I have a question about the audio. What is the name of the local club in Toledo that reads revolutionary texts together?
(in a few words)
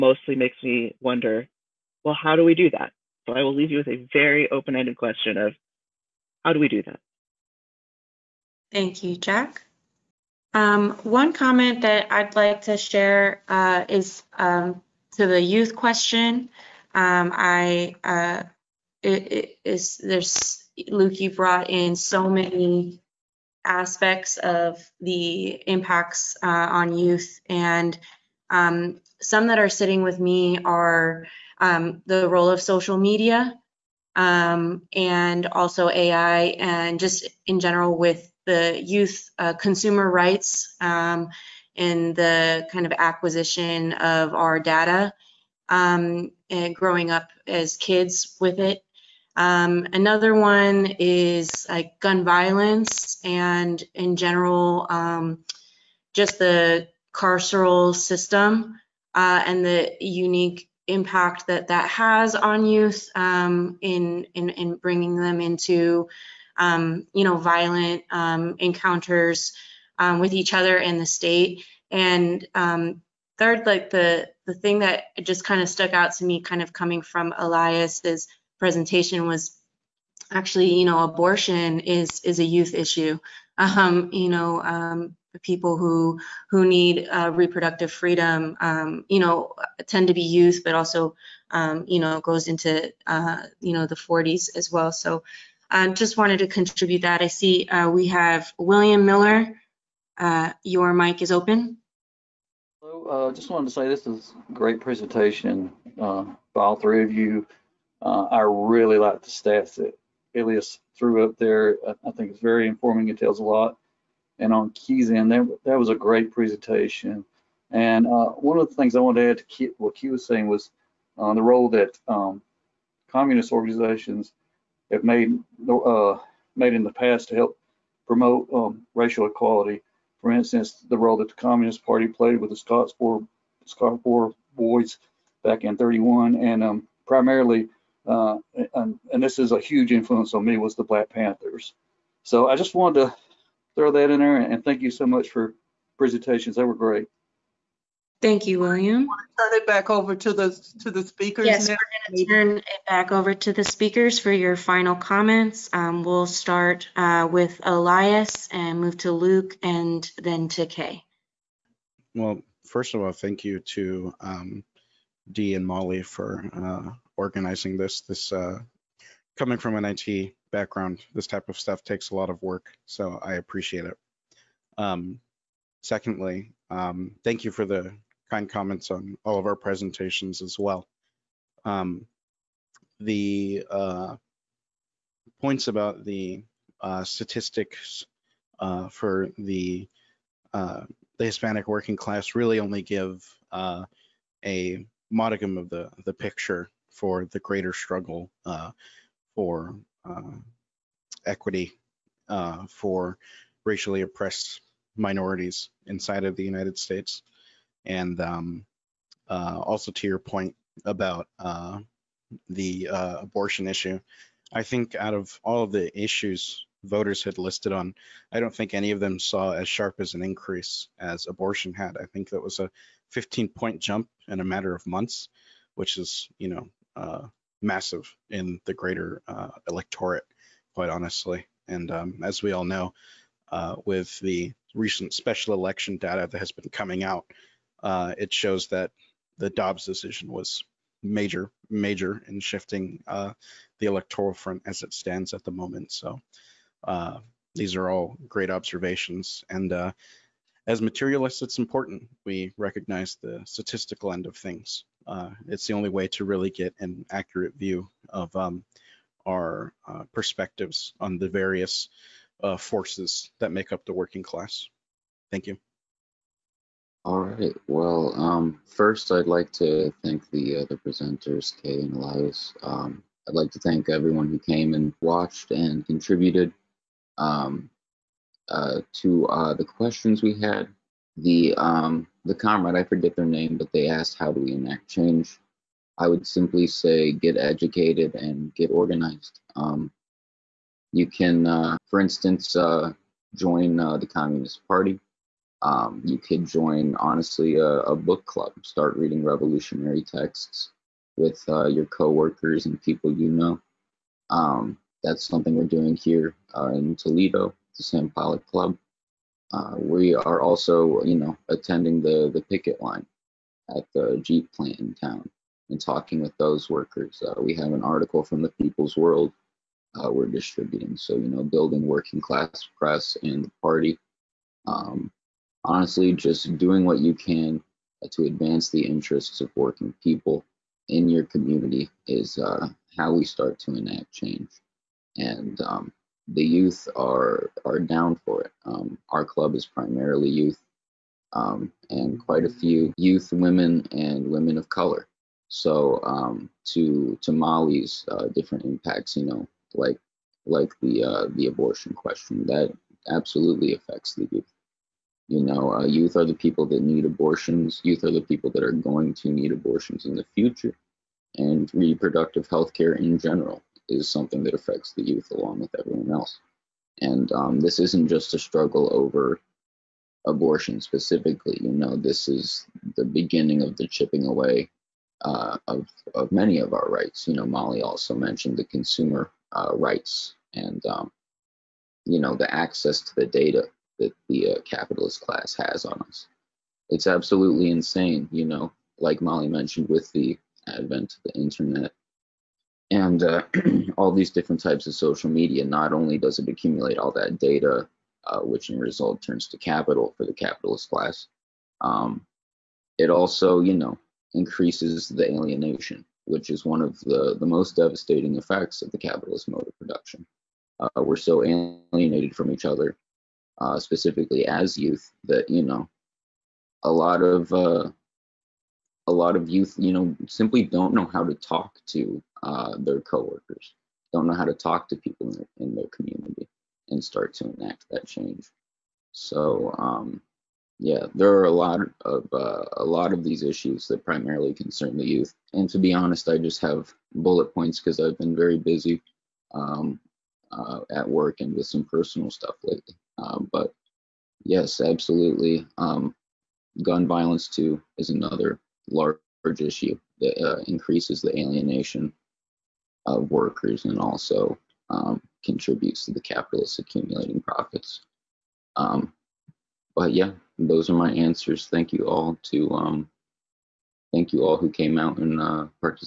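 Sam Pollock Club.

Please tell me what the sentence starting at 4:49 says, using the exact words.
Um, you can, uh, for instance, uh, join uh, the Communist Party um, you could join, honestly, a, a, book club.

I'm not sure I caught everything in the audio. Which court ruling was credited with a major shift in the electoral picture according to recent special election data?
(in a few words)
Dobbs decision.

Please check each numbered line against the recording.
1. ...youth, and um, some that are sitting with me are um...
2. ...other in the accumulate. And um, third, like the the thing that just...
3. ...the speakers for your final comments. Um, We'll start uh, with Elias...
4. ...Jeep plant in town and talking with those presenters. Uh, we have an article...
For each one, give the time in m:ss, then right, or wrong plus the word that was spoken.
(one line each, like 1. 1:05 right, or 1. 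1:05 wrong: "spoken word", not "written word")
1. 0:26 right
2. 1:10 wrong: "state", not "accumulate"
3. 2:33 right
4. 5:14 wrong: "workers", not "presenters".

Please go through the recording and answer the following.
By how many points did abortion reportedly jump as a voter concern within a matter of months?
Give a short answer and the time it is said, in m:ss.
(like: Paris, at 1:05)
15, at 3:43.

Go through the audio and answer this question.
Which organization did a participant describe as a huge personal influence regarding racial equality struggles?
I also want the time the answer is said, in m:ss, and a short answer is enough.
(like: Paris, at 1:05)
Black Panthers, at 2:20.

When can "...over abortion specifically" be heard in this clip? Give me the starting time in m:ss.
6:08.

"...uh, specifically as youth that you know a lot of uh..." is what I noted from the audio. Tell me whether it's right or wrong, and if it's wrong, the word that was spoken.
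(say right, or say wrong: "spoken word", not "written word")
right.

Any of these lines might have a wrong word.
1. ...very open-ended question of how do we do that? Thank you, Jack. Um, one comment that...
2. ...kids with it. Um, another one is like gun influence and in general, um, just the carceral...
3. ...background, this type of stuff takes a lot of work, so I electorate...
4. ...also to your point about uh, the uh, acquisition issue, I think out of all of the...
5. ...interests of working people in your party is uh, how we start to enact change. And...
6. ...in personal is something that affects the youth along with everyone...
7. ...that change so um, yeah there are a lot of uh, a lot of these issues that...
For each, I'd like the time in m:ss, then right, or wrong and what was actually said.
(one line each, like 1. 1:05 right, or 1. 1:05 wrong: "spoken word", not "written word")
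1. 0:04 right
2. 0:47 wrong: "violence", not "influence"
3. 2:50 wrong: "appreciate", not "electorate"
4. 3:29 wrong: "abortion", not "acquisition"
5. 5:28 wrong: "community", not "party"
6. 6:02 wrong: "general", not "personal"
7. 7:07 right.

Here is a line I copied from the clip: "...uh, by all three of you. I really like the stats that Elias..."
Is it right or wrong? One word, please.
right.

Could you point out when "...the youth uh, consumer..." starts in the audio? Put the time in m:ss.
0:38.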